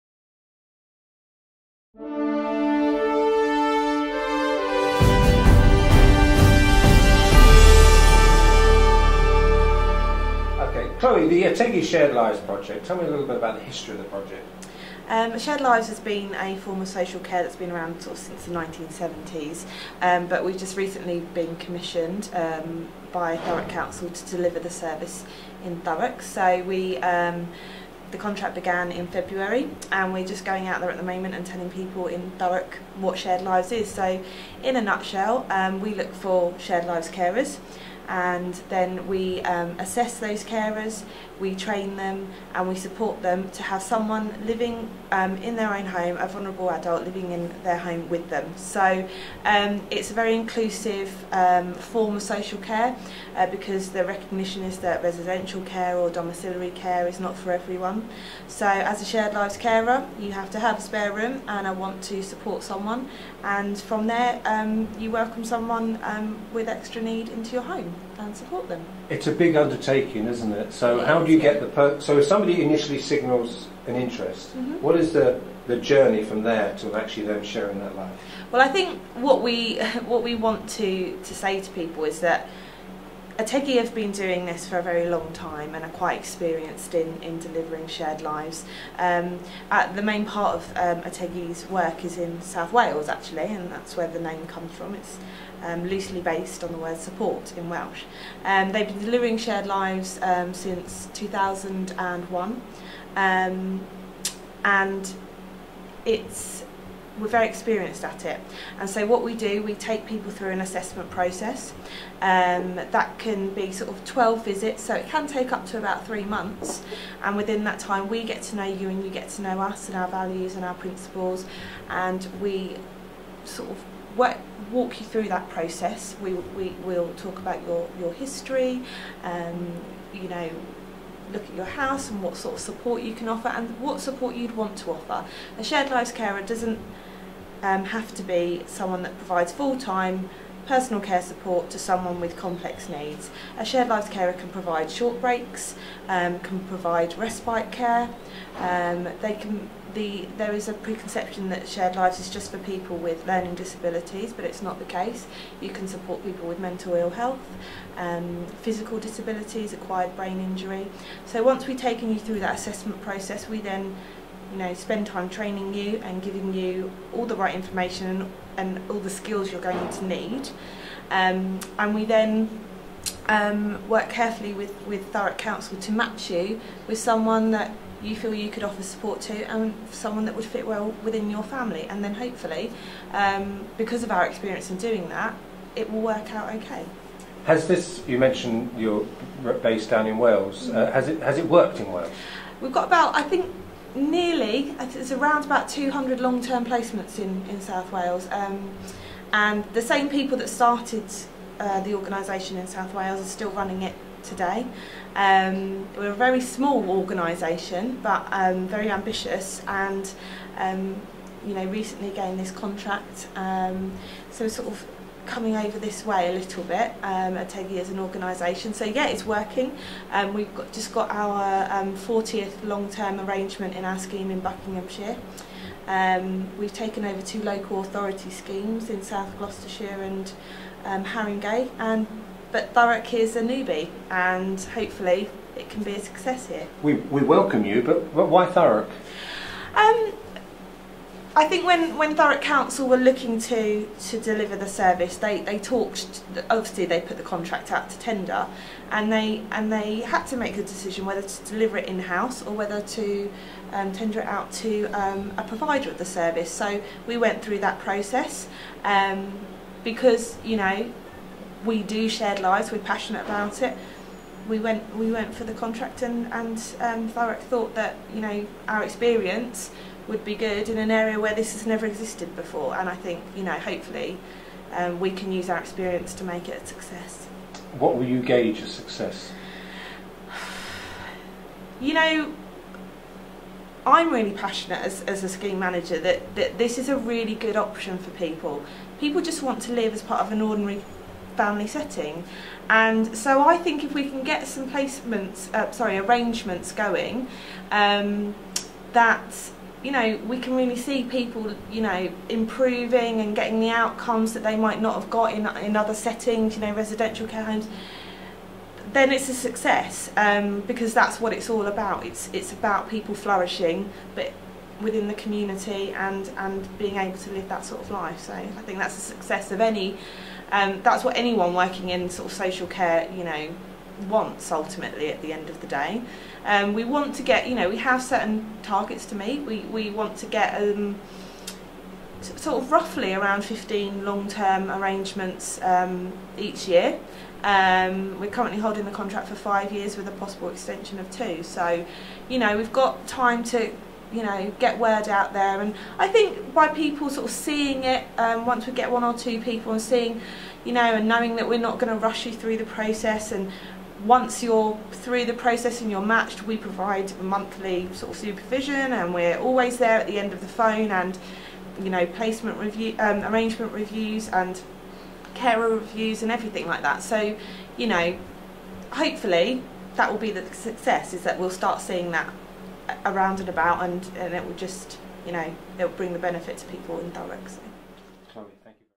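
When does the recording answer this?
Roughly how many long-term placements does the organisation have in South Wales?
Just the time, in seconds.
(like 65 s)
195 s.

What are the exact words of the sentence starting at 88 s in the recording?
Um, at the main part of um, Ategi's work is in South Wales actually and that's where the name comes from.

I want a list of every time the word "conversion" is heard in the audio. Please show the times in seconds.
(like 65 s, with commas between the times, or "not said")
not said.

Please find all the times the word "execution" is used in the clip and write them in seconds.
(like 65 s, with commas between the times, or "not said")
not said.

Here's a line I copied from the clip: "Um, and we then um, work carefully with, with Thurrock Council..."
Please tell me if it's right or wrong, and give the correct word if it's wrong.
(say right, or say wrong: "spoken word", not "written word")
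right.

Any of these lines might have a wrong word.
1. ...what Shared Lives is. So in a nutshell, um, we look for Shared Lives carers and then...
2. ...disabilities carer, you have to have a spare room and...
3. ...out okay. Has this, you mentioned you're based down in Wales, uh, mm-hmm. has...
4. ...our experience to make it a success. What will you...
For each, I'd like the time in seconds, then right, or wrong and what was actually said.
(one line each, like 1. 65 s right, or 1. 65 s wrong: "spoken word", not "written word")
1. 32 s right
2. 59 s wrong: "lives", not "disabilities"
3. 186 s right
4. 275 s right.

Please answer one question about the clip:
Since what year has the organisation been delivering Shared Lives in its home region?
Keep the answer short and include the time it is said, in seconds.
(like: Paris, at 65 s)
2001, at 101 s.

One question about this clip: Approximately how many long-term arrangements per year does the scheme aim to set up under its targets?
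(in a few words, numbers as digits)
15.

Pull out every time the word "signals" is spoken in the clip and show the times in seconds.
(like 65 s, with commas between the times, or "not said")
72 s.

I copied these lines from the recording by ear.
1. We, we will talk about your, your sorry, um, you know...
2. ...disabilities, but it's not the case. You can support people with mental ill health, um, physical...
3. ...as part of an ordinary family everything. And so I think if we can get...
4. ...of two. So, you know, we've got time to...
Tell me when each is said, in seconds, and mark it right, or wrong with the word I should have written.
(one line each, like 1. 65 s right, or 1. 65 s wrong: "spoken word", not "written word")
1. 126 s wrong: "history", not "sorry"
2. 153 s right
3. 289 s wrong: "setting", not "everything"
4. 340 s right.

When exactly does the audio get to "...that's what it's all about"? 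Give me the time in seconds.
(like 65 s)
310 s.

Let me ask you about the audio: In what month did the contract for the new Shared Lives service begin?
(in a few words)
February.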